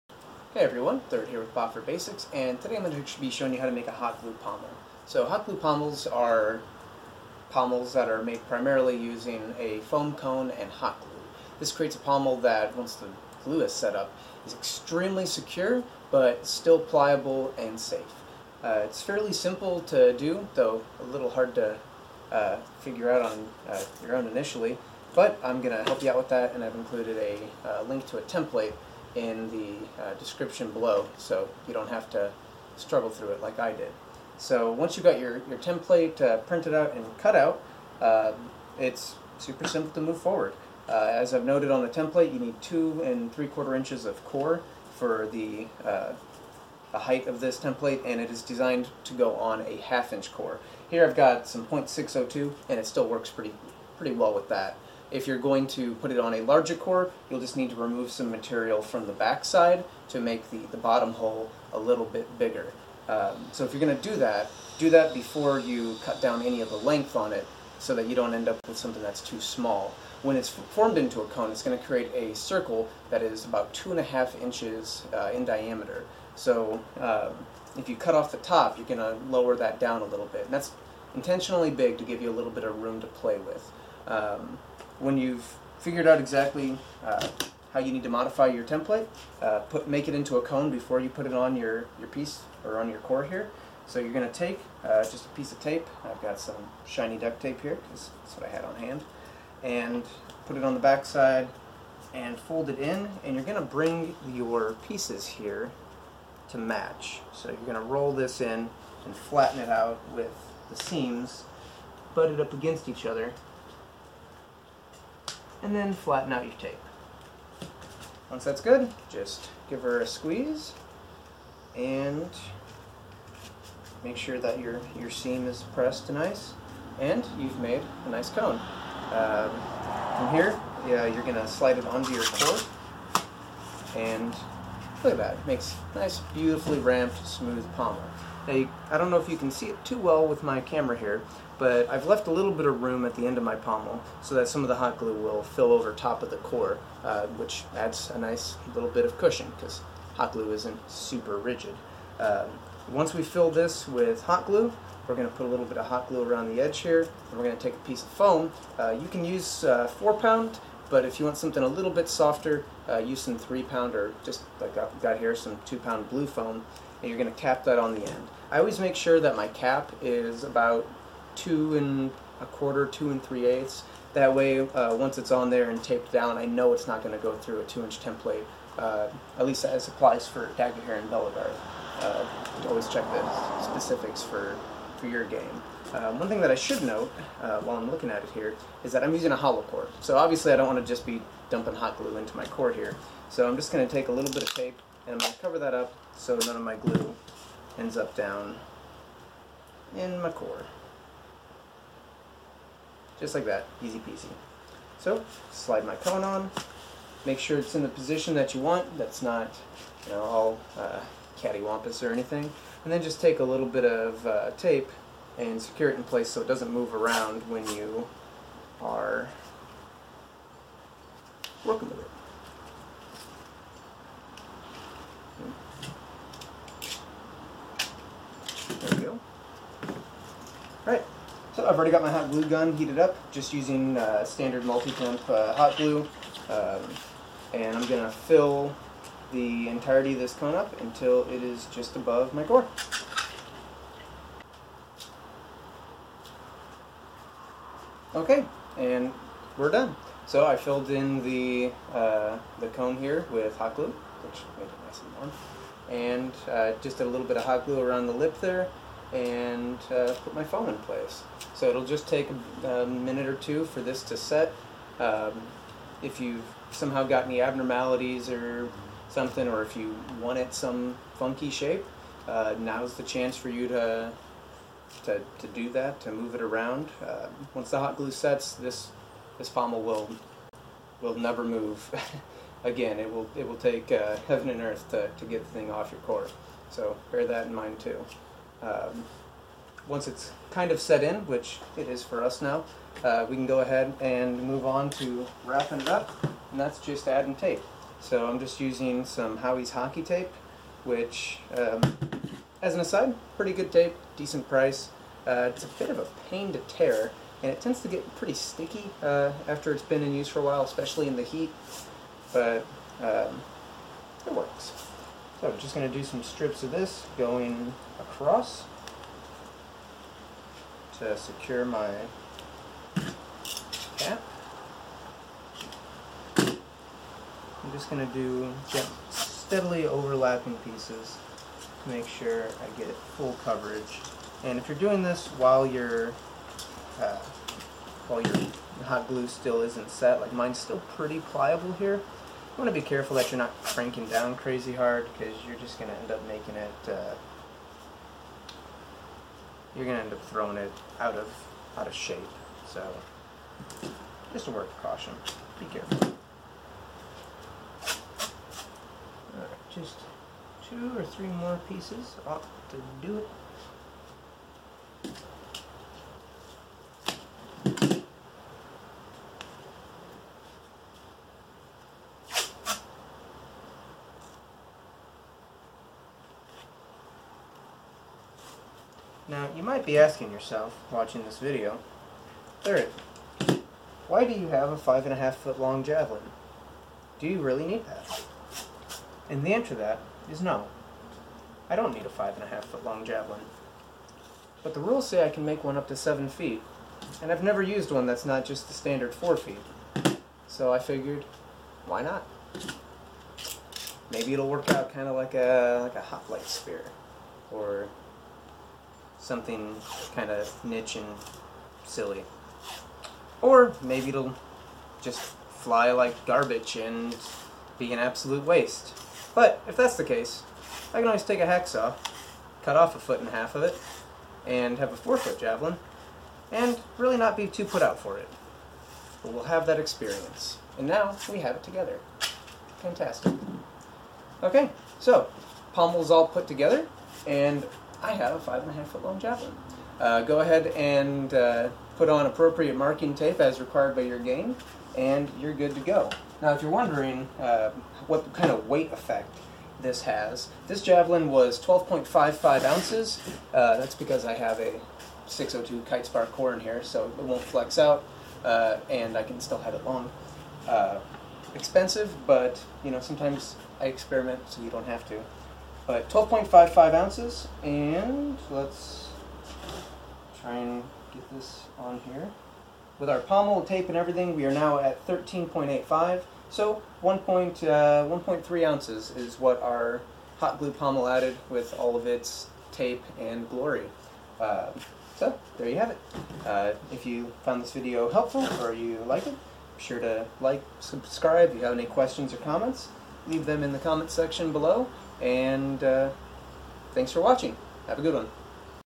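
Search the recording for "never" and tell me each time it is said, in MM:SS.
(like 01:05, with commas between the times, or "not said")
04:41, 06:37.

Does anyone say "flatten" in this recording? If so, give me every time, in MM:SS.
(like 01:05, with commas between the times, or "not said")
01:49, 01:55.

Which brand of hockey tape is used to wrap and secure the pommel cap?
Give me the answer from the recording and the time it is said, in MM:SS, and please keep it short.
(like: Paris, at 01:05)
Howie's, at 04:59.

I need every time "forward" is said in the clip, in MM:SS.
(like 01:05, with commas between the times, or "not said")
00:40.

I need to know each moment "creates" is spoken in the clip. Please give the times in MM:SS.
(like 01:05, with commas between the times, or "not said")
00:11, 01:11.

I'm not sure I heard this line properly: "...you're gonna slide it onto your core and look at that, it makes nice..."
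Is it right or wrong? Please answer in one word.
right.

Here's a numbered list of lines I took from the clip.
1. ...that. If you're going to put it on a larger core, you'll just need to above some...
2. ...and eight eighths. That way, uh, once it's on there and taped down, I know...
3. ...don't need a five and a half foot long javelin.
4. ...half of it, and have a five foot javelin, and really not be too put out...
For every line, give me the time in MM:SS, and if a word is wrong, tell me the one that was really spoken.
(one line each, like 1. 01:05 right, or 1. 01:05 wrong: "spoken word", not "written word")
1. 00:54 wrong: "remove", not "above"
2. 02:53 wrong: "three", not "eight"
3. 06:31 right
4. 07:03 wrong: "four", not "five".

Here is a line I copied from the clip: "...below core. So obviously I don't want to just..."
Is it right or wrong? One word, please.
wrong.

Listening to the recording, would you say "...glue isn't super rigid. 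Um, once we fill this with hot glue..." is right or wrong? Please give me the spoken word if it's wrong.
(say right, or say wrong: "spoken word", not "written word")
right.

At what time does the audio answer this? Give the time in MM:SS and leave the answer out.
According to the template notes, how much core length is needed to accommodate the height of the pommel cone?
00:42.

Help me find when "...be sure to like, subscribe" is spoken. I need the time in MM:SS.
08:09.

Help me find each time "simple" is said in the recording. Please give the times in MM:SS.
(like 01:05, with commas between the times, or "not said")
00:19, 00:39.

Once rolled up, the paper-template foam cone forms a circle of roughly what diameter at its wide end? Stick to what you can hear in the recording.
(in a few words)
2.5 inches.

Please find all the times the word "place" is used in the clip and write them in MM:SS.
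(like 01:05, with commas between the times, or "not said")
03:36, 04:20.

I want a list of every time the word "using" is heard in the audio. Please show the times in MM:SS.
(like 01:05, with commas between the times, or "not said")
00:08, 03:09, 03:53, 04:58.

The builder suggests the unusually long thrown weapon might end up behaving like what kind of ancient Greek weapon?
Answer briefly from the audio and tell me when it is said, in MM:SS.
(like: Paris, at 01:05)
hoplite spear, at 06:46.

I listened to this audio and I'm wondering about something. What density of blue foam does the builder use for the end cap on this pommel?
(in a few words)
2 pound.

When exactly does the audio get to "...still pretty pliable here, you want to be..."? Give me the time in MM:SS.
05:40.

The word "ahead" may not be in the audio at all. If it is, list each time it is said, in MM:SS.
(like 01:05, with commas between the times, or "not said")
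04:53, 07:20.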